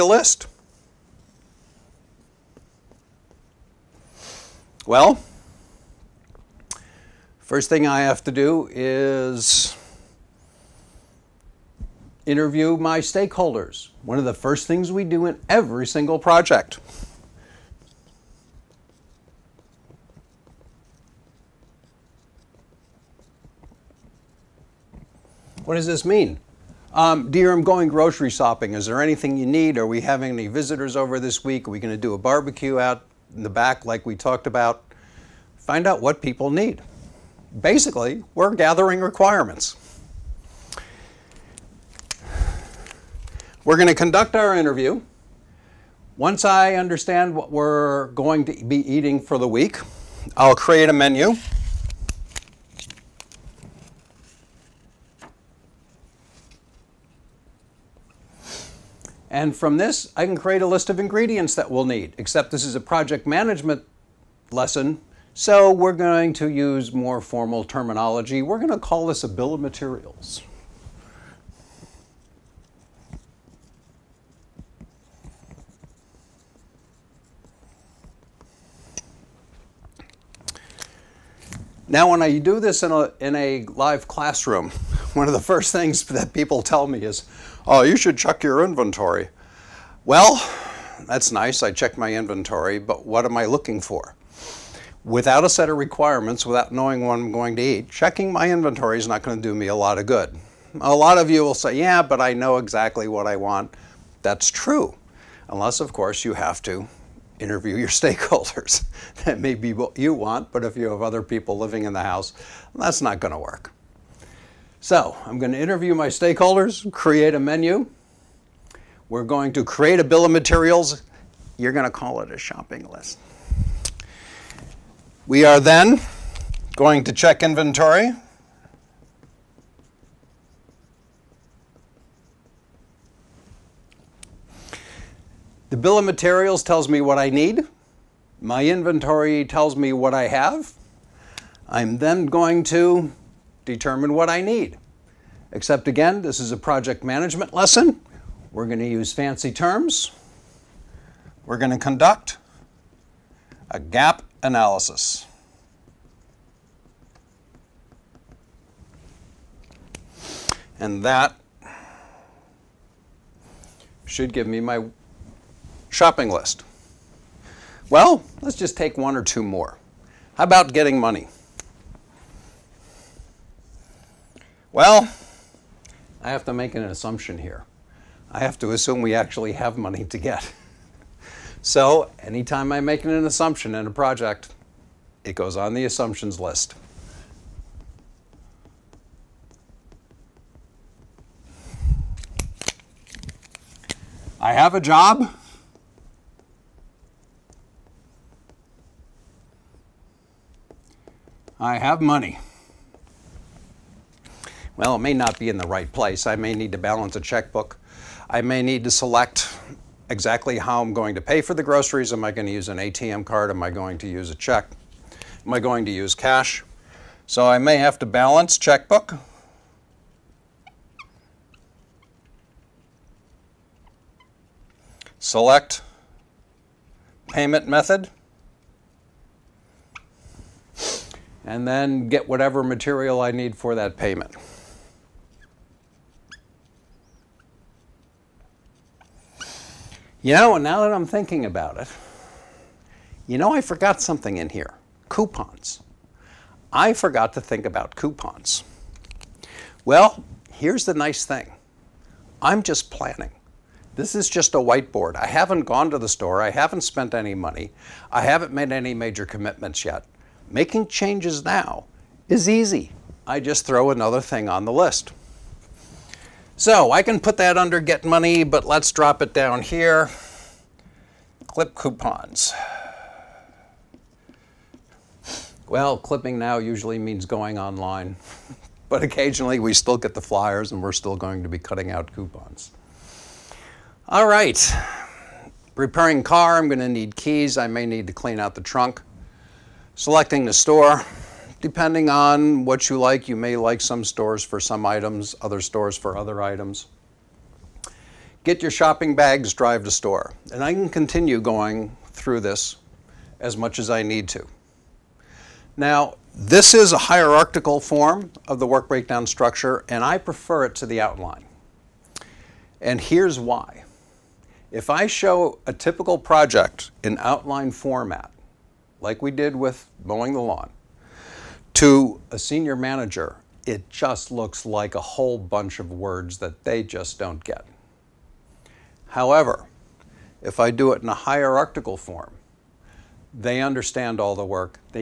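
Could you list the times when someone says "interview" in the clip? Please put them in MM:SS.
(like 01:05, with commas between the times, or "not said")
00:12, 00:44, 01:47, 01:55.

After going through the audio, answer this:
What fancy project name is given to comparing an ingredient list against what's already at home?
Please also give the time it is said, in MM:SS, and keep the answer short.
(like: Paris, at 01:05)
gap analysis, at 02:33.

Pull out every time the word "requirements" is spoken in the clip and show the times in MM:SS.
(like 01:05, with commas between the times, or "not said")
00:39, 01:35.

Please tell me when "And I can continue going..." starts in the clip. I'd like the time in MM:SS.
05:00.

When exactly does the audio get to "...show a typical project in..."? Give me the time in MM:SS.
05:15.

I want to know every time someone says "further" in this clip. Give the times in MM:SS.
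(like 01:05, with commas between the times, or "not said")
not said.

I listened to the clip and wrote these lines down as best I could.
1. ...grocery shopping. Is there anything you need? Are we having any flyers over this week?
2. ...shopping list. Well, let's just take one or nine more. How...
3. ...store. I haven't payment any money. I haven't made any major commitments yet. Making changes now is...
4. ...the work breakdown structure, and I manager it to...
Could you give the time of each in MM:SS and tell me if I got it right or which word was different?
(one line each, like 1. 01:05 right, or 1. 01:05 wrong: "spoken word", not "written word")
1. 00:27 wrong: "visitors", not "flyers"
2. 02:45 wrong: "two", not "nine"
3. 04:16 wrong: "spent", not "payment"
4. 05:08 wrong: "prefer", not "manager".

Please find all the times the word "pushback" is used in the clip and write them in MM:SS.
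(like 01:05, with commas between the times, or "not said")
not said.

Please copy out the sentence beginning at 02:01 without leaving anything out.
You're going to call it a shopping list.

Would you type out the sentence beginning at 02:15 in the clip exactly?
The bill of materials tells me what I need.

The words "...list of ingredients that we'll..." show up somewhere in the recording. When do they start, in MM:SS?
01:00.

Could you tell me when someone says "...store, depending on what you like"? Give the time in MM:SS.
04:50.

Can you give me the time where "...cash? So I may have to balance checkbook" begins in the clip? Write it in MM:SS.
03:36.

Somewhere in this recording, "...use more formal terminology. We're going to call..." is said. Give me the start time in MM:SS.
01:06.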